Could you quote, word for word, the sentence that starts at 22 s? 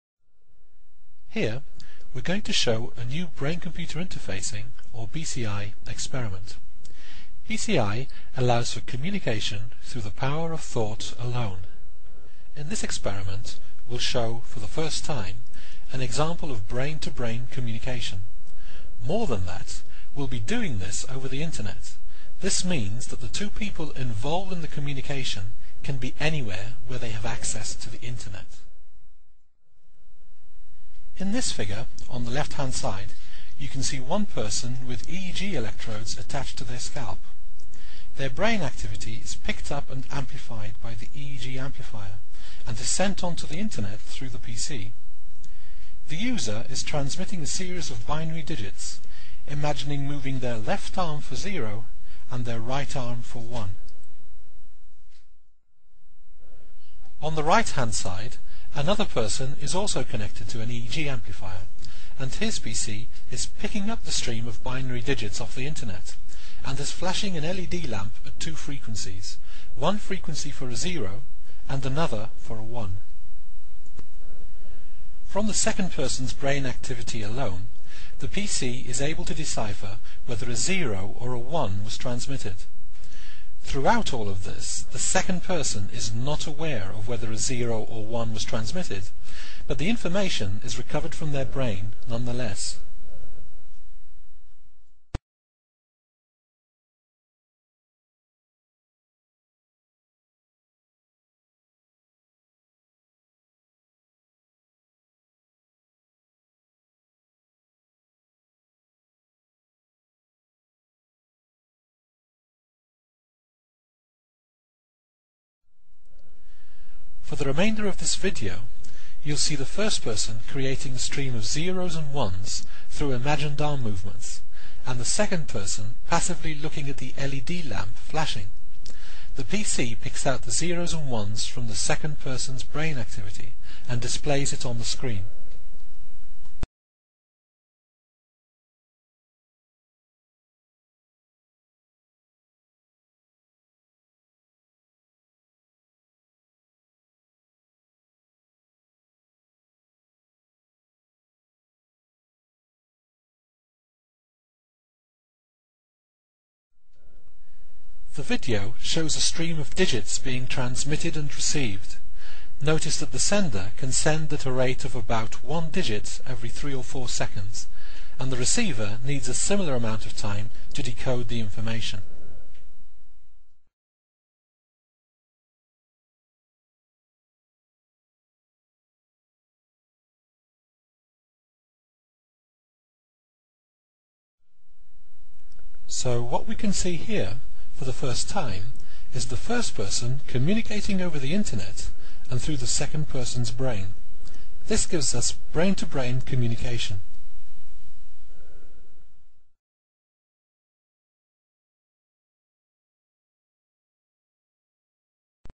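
This means that the two people involved in the communication can be anywhere where they have access to the Internet.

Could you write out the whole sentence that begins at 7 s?
BCI allows for communication through the power of thought alone.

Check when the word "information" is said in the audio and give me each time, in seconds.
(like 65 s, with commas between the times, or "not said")
89 s, 171 s.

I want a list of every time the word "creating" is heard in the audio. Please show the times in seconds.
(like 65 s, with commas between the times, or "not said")
120 s.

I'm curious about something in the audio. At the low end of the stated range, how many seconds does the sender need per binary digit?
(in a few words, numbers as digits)
3.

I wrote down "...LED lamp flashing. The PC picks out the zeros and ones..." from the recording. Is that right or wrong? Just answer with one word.
right.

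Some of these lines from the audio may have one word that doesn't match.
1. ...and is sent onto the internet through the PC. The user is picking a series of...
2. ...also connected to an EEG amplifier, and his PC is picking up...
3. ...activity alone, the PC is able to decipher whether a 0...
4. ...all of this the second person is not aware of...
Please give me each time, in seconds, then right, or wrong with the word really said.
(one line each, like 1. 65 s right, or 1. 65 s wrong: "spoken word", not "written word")
1. 42 s wrong: "transmitting", not "picking"
2. 59 s right
3. 76 s right
4. 84 s right.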